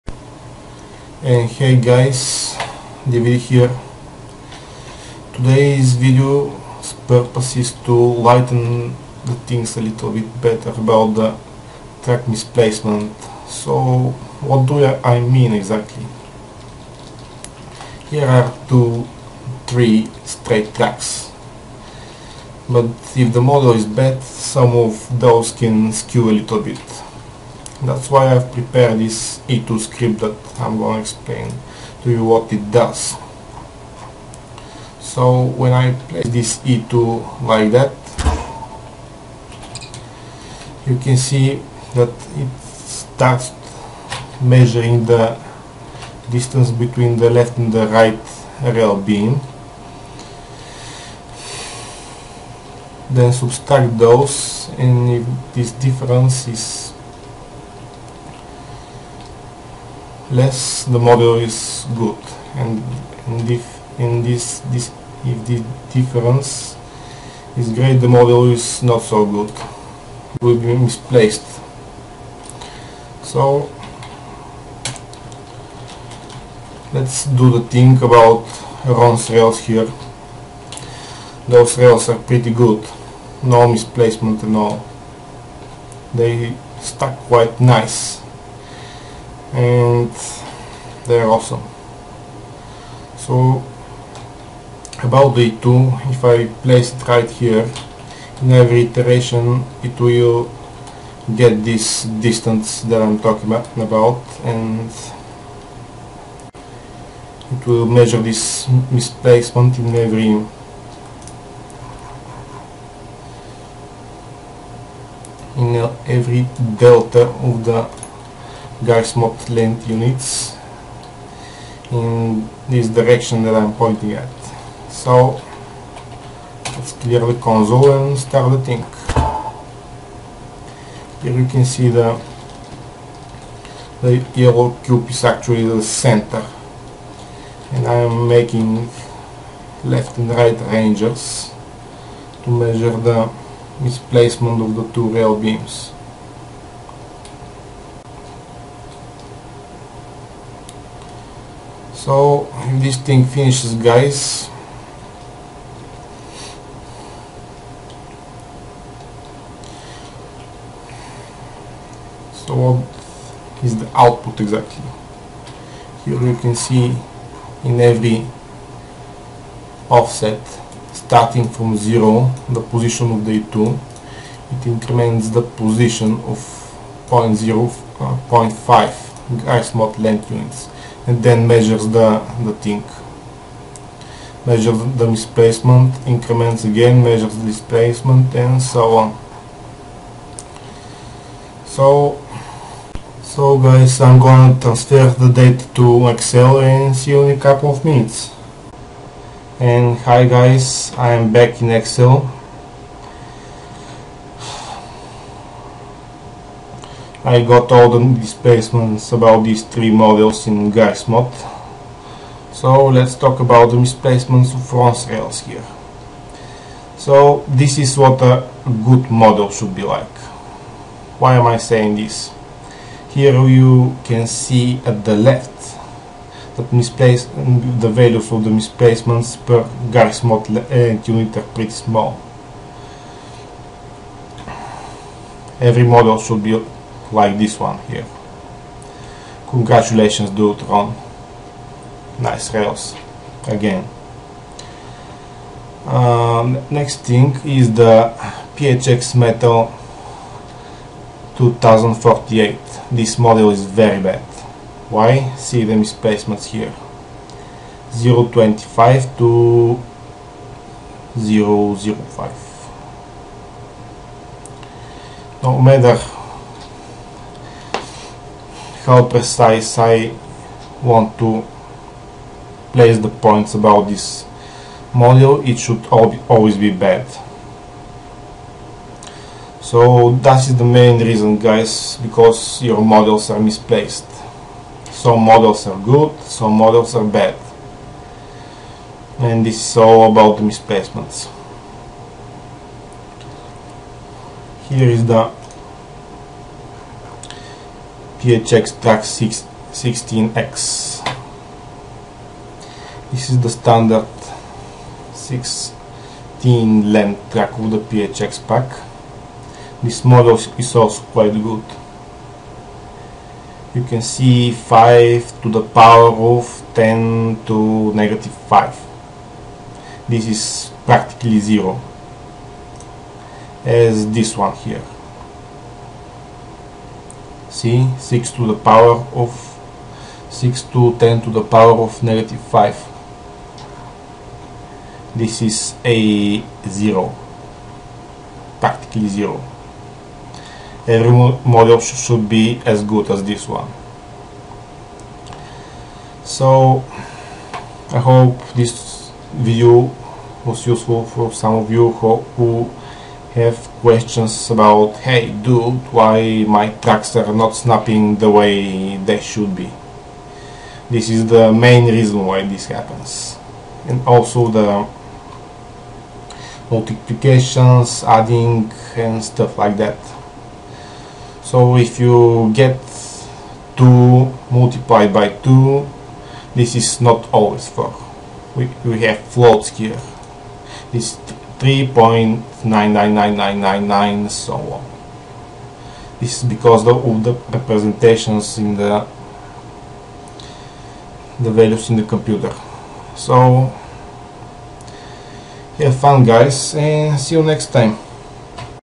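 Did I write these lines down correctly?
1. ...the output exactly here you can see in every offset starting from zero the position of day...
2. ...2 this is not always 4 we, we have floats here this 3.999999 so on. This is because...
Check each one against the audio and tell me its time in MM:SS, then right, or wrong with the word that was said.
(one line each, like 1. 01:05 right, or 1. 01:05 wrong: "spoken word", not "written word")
1. 02:43 right
2. 06:15 right.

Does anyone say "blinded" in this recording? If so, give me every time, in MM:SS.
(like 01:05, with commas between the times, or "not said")
not said.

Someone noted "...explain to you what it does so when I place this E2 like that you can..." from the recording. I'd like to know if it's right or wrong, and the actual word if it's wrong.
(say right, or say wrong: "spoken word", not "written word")
right.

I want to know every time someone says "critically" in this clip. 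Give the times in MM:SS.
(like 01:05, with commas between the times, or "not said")
not said.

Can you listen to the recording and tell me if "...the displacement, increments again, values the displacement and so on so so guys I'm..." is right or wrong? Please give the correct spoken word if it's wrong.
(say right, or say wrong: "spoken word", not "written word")
wrong: "measures", not "values".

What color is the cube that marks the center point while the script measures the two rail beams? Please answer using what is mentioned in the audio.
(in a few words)
yellow.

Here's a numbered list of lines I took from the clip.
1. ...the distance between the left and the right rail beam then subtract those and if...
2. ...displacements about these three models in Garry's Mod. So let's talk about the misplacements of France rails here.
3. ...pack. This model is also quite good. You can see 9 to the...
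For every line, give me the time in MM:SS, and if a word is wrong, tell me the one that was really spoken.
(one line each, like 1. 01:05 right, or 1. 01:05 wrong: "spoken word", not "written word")
1. 00:45 right
2. 03:28 wrong: "displacements", not "misplacements"
3. 05:08 wrong: "5", not "9".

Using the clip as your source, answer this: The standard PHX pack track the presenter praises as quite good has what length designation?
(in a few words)
16.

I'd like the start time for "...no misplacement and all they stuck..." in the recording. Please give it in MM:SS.
01:23.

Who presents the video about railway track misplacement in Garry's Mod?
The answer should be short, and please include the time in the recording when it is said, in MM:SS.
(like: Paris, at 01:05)
David, at 00:03.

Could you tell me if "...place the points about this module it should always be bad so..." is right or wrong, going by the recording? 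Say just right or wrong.
right.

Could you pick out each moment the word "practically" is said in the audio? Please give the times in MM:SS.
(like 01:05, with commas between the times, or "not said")
05:20, 05:38.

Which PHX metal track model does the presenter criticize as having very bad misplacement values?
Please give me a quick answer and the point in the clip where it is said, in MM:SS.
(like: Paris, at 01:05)
PHX Metal 2048, at 04:08.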